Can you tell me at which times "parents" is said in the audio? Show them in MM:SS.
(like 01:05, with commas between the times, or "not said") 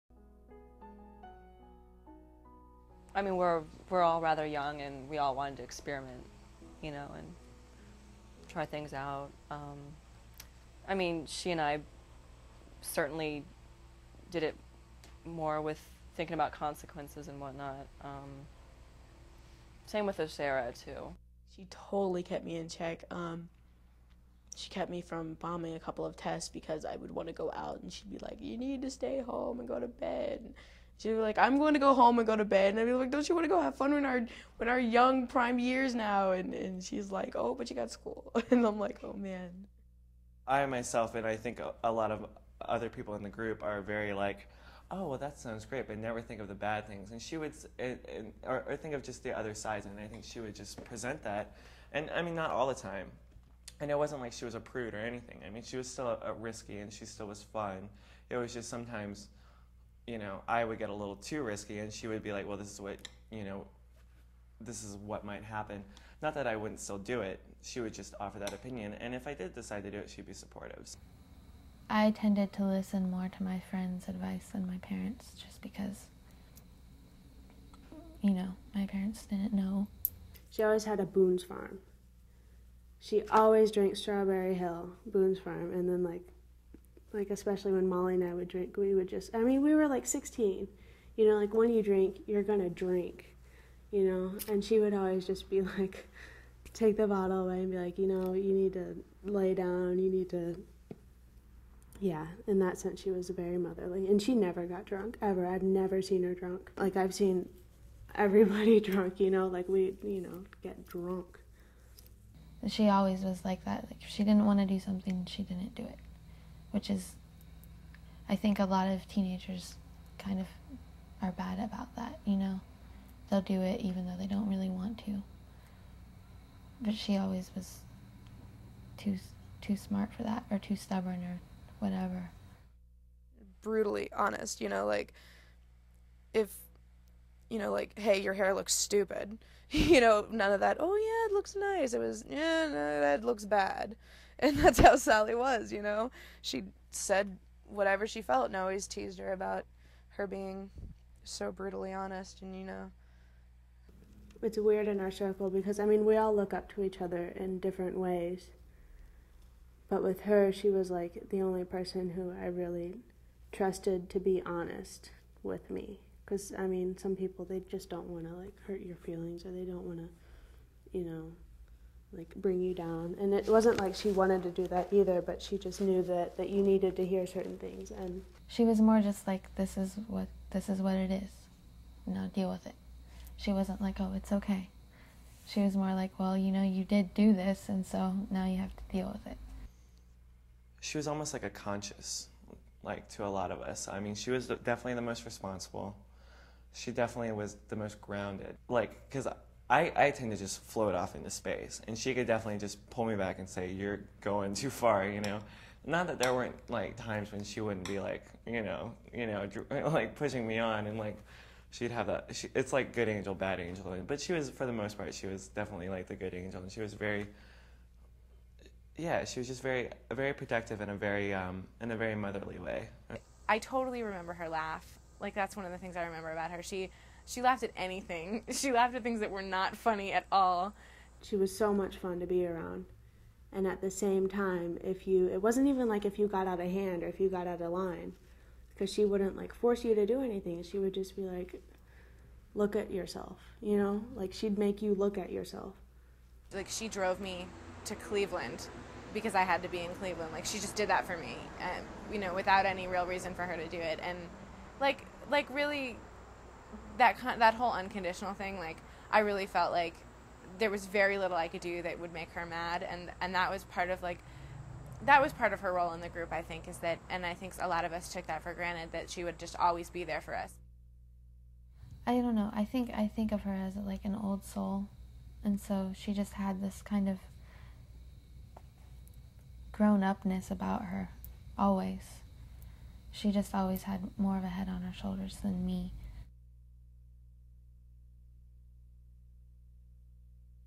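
01:14, 01:18.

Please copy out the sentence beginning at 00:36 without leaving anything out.
And, and she's like, oh, but you got school.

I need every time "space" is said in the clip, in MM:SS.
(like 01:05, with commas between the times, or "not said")
03:21.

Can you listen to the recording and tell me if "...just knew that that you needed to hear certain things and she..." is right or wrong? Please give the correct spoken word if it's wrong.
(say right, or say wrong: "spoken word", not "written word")
right.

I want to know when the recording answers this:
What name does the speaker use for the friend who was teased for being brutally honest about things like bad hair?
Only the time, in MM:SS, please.
02:24.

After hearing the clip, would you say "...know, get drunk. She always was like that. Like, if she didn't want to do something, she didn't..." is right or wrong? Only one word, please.
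right.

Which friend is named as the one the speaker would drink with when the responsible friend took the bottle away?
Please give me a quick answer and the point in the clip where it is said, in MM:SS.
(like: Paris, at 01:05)
Molly, at 01:27.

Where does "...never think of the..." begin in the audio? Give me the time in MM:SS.
00:45.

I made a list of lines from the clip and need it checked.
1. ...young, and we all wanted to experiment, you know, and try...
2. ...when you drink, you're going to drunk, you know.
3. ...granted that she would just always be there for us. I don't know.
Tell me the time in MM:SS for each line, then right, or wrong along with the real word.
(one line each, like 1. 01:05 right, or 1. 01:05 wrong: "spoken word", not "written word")
1. 00:04 right
2. 01:31 wrong: "drink", not "drunk"
3. 04:28 right.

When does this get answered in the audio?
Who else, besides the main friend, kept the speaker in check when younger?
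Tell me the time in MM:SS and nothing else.
00:20.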